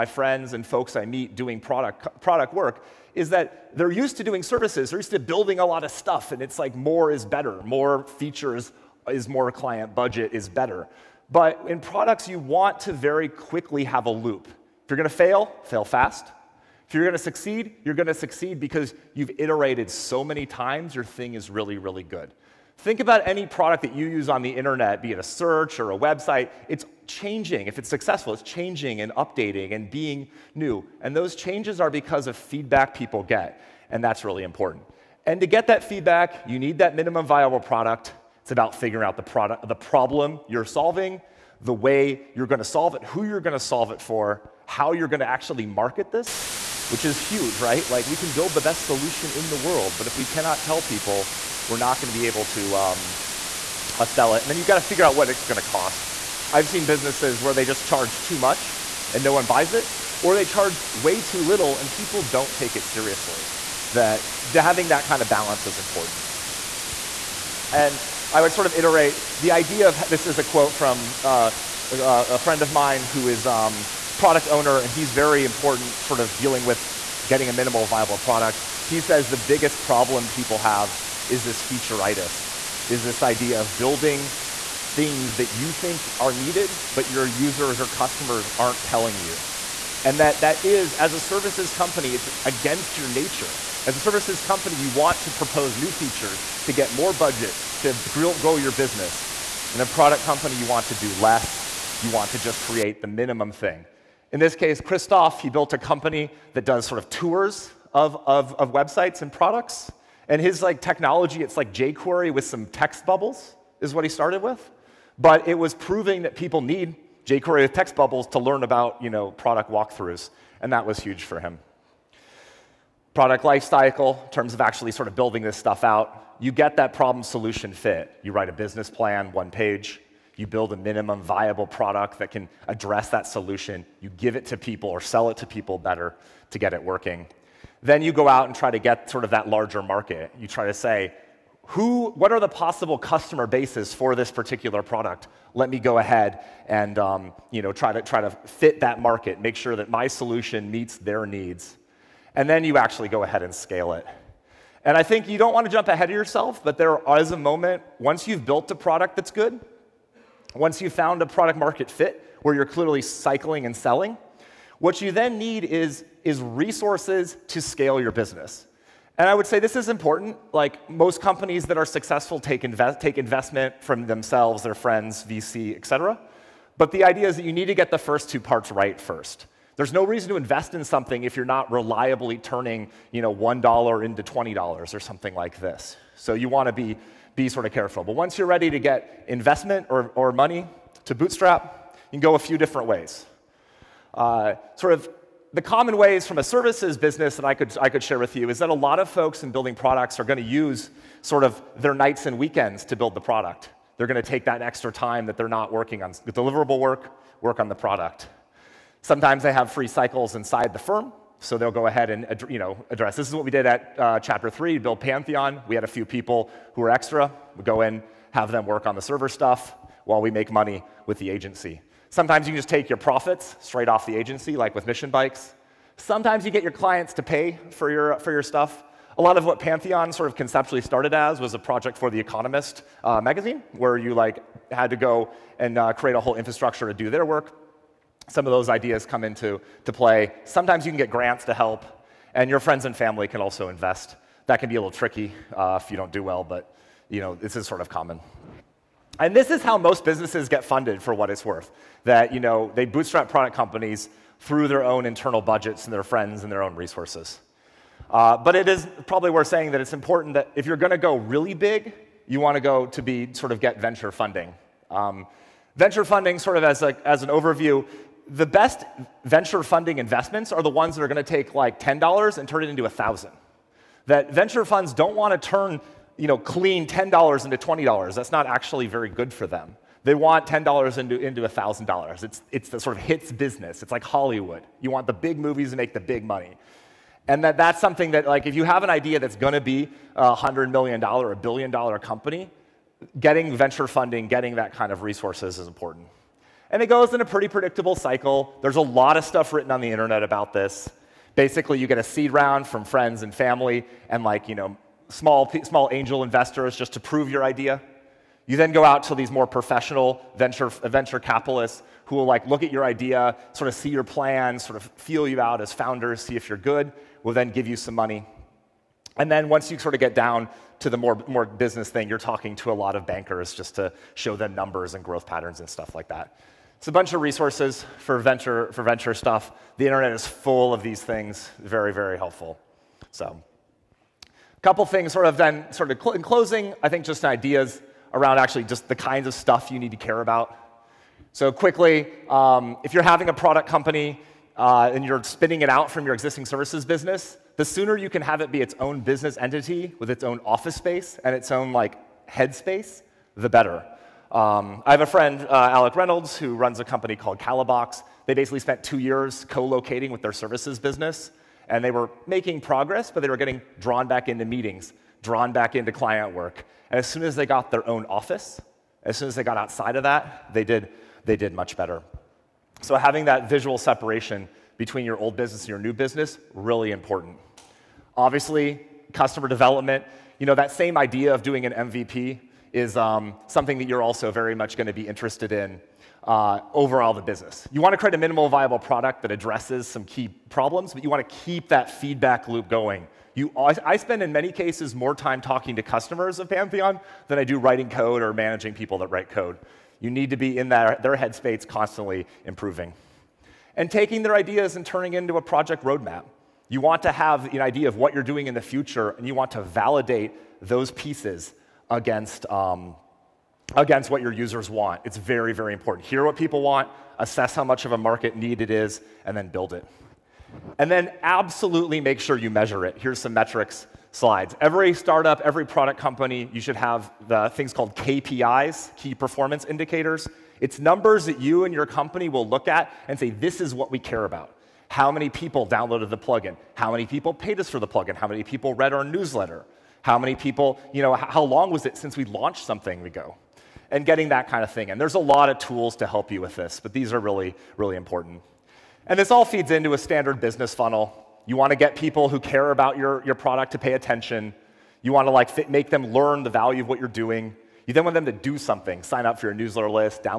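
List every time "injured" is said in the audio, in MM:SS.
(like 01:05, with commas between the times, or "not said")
not said.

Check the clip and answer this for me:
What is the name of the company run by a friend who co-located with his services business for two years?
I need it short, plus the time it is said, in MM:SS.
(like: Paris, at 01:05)
Kalabox, at 05:57.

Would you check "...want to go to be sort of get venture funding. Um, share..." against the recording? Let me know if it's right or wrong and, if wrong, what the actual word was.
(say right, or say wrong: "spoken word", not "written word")
wrong: "venture", not "share".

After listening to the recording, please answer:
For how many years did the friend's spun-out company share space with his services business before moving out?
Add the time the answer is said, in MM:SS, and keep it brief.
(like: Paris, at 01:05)
2, at 05:58.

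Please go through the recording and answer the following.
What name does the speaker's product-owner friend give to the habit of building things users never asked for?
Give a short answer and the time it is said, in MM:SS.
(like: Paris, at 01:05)
featureitis, at 01:21.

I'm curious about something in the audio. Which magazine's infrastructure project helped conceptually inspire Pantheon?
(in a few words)
The Economist.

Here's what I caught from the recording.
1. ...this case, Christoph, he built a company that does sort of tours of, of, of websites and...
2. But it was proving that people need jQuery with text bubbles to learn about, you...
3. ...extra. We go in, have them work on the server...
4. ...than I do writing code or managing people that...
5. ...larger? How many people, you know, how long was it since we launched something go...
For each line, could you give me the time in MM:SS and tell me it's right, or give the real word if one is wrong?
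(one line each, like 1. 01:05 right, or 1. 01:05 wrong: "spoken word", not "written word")
1. 01:44 right
2. 01:55 right
3. 03:36 right
4. 06:37 right
5. 07:19 wrong: "newsletter", not "larger".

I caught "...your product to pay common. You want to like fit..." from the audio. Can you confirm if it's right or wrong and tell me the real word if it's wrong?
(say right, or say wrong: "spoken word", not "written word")
wrong: "attention", not "common".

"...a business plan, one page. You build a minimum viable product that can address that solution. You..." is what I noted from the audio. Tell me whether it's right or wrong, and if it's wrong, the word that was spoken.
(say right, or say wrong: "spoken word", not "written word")
right.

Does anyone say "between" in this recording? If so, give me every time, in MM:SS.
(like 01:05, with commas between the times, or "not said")
06:14.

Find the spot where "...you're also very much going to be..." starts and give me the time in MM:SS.
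06:23.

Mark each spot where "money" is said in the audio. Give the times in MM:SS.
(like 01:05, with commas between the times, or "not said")
03:10, 03:40, 04:46, 05:17.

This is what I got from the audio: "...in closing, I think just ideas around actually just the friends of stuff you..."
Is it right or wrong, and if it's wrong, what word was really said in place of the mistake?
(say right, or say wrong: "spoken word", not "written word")
wrong: "kinds", not "friends".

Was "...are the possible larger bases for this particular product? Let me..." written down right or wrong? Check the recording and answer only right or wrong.
wrong.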